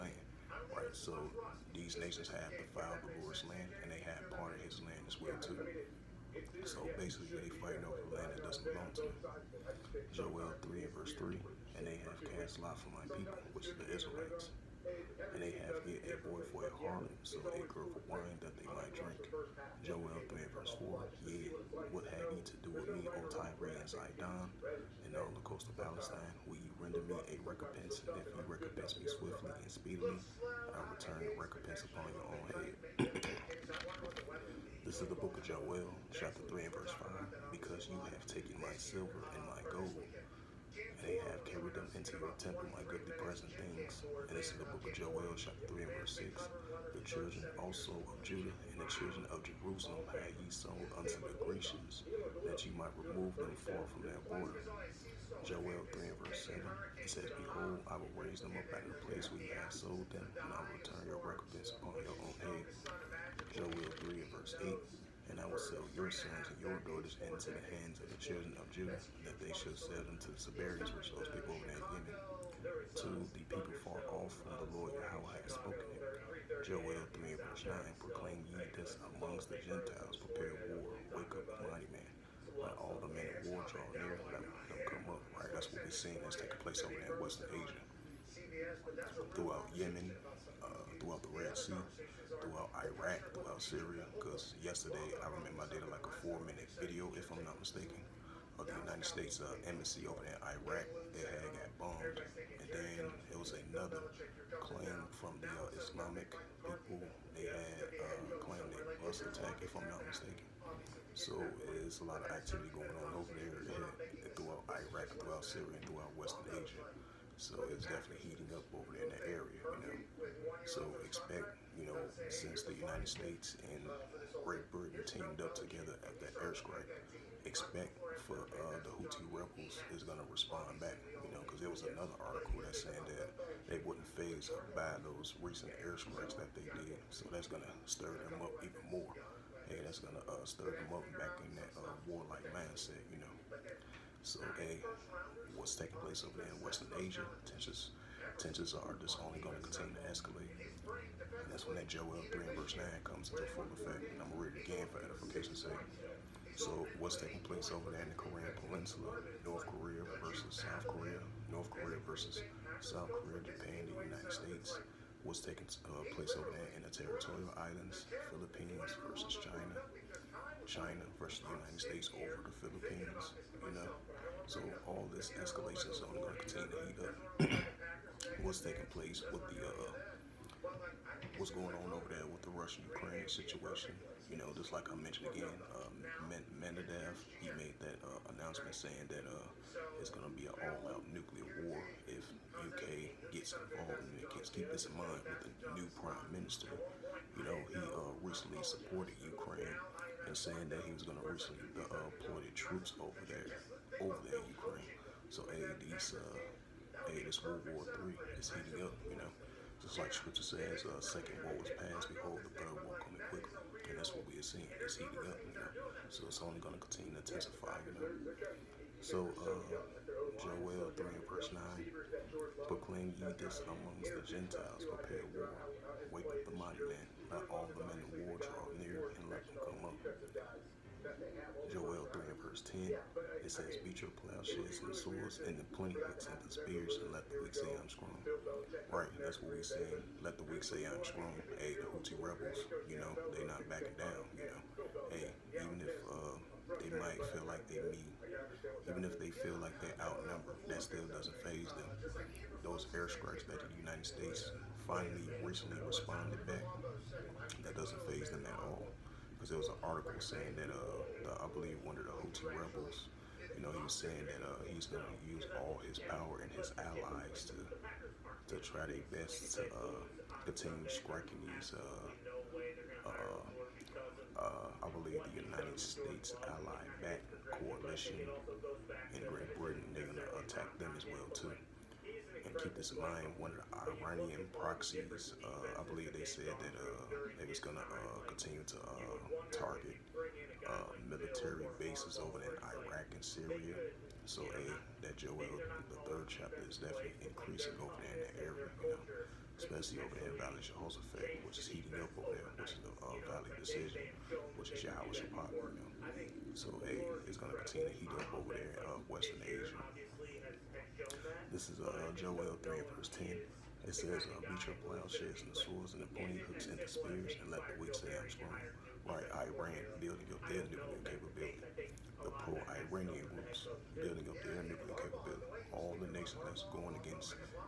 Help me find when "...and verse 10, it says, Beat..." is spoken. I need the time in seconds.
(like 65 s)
232 s.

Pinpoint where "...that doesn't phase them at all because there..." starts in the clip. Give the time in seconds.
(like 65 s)
257 s.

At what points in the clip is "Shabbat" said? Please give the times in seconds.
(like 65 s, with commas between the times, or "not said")
305 s.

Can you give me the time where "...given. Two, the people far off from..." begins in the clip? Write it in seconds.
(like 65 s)
71 s.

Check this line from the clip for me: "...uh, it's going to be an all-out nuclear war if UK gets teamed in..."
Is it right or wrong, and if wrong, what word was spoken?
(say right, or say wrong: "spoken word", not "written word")
wrong: "involved", not "teamed".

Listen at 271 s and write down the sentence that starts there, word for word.
Uh, uh, uh, I believe the United States allied back coalition in Great Britain.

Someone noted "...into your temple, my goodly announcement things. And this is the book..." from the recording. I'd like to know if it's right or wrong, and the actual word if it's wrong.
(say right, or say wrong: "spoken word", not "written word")
wrong: "present", not "announcement".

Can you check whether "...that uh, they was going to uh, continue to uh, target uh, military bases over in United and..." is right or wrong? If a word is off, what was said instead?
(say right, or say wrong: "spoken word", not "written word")
wrong: "Iraq", not "United".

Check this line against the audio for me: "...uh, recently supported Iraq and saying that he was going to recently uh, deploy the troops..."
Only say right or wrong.
wrong.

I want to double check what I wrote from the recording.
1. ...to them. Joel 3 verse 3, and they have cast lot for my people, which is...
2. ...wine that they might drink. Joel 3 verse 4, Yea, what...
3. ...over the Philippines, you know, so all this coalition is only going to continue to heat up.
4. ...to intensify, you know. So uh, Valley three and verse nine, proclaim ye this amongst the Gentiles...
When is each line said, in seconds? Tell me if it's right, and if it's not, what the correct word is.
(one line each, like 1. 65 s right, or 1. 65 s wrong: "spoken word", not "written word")
1. 8 s right
2. 18 s right
3. 172 s wrong: "escalation", not "coalition"
4. 217 s wrong: "Joel", not "Valley".